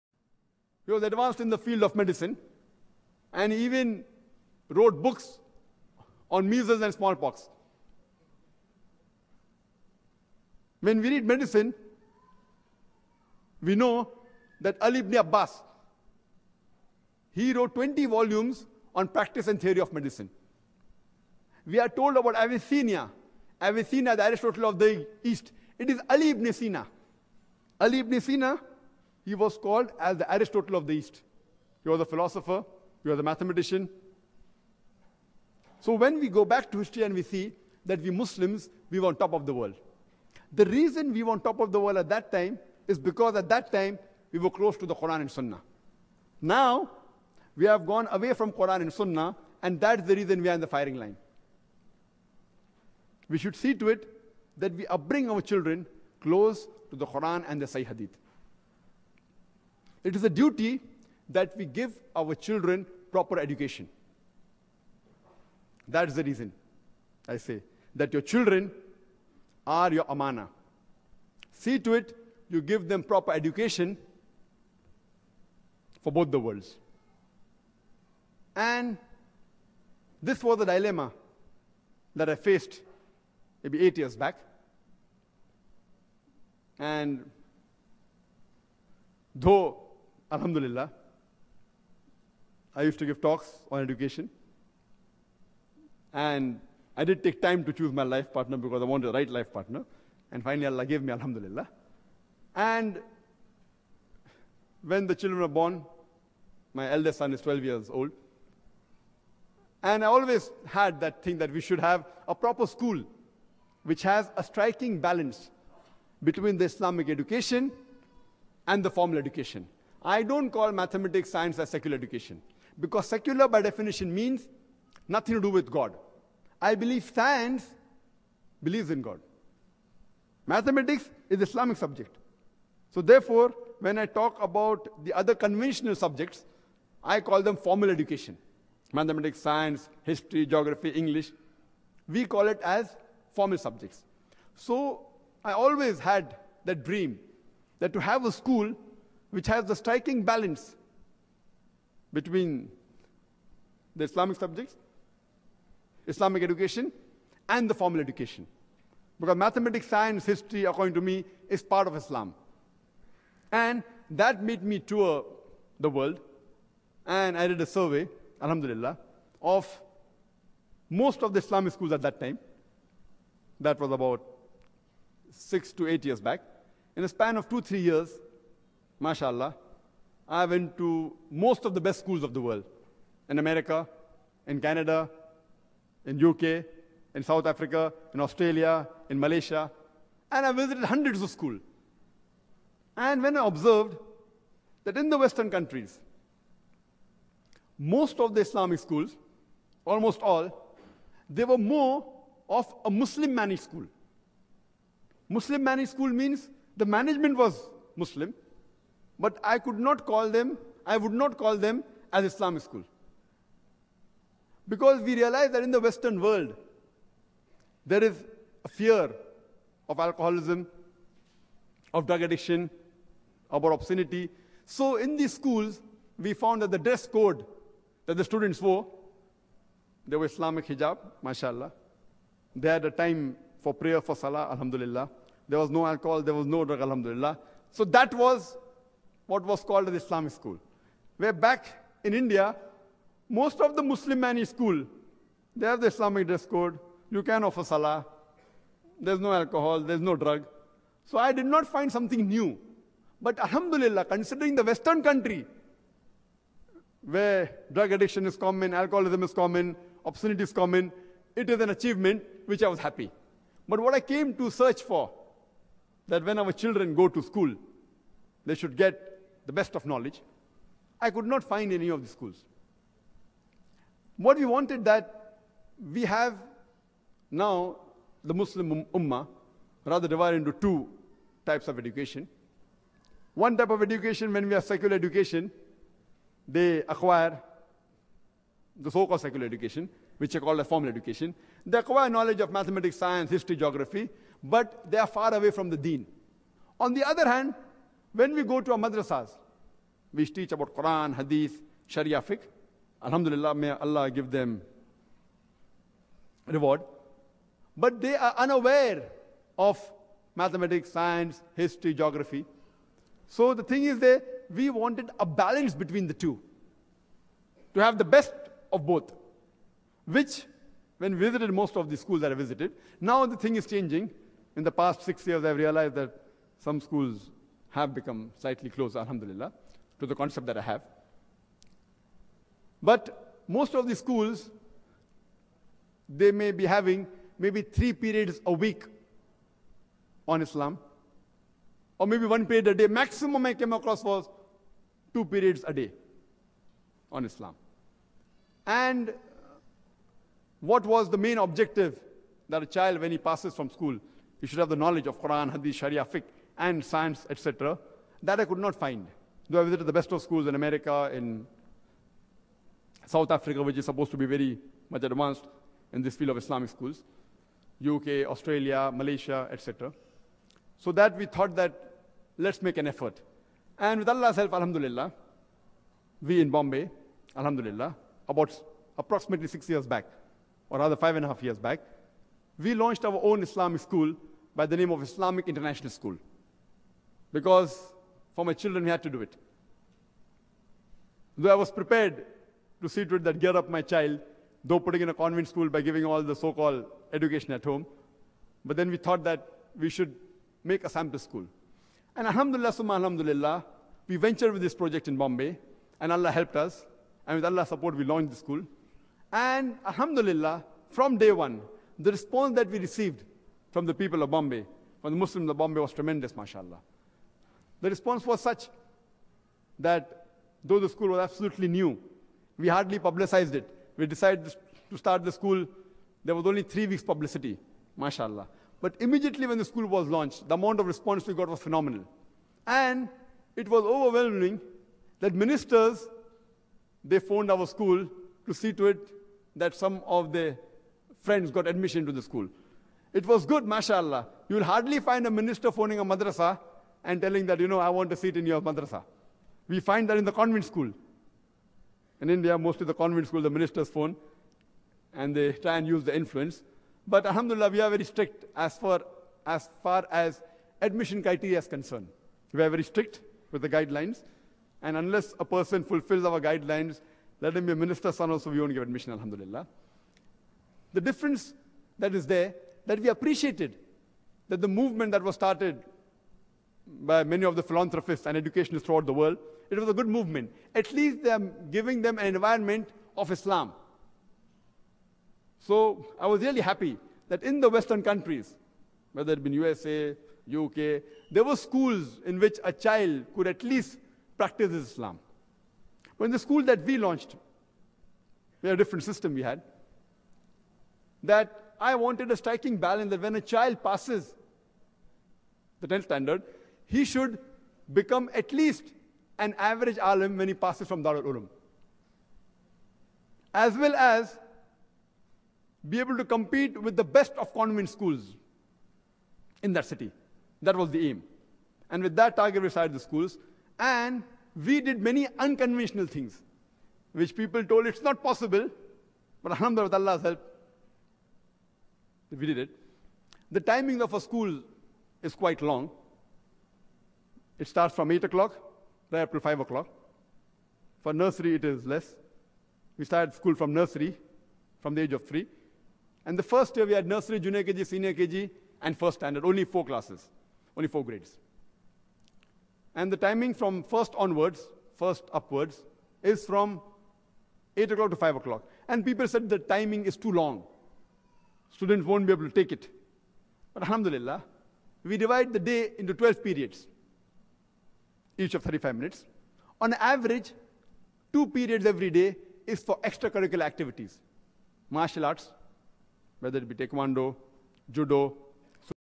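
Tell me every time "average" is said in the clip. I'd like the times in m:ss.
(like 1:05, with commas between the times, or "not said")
8:29, 9:29.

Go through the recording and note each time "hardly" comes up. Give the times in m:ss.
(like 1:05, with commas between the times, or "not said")
7:02, 7:24.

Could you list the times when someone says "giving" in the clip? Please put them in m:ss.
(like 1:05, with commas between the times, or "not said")
6:35, 8:01.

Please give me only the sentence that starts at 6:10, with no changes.
So that we thought that let's make an effort.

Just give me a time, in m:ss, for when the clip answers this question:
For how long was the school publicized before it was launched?
7:06.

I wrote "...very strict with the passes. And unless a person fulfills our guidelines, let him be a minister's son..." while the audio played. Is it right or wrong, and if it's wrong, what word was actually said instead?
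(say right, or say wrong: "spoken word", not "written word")
wrong: "guidelines", not "passes".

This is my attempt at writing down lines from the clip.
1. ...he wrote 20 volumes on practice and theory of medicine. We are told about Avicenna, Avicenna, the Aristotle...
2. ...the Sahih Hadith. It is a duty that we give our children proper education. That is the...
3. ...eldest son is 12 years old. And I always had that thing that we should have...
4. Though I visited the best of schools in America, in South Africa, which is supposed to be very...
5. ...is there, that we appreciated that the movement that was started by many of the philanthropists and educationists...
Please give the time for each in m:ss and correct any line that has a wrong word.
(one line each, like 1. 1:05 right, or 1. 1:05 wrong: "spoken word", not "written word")
1. 0:17 right
2. 0:57 right
3. 1:46 right
4. 5:59 right
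5. 7:52 right.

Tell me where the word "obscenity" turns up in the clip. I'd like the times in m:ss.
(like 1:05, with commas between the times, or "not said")
3:43, 4:20.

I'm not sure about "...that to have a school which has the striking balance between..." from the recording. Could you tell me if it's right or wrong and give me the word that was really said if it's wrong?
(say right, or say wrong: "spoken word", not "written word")
right.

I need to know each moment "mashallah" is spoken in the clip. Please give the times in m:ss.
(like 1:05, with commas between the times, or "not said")
2:59, 3:51, 6:56, 7:07, 7:23.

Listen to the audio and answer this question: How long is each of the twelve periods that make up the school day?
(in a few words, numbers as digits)
35 minutes.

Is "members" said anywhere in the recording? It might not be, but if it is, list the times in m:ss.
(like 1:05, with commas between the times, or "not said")
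not said.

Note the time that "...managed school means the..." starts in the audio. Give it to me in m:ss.
3:25.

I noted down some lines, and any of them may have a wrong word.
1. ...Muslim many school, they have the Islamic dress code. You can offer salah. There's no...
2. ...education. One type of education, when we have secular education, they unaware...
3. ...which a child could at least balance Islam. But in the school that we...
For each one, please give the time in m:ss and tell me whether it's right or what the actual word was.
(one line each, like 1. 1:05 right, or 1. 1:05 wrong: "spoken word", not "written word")
1. 4:03 right
2. 4:41 wrong: "acquire", not "unaware"
3. 8:12 wrong: "practice", not "balance".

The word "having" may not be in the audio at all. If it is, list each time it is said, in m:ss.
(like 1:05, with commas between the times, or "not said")
5:36.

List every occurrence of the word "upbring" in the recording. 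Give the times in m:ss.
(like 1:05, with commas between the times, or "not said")
0:54.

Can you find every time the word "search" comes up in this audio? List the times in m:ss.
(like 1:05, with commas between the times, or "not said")
4:24.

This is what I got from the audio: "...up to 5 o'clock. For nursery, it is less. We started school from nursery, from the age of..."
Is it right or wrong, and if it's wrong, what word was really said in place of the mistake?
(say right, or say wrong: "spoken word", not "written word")
right.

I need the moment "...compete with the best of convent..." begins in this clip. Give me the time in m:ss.
8:36.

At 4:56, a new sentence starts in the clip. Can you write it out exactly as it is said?
On the other hand, when we go to our madrasas, we teach about Quran, Hadith, Sharia fiqh.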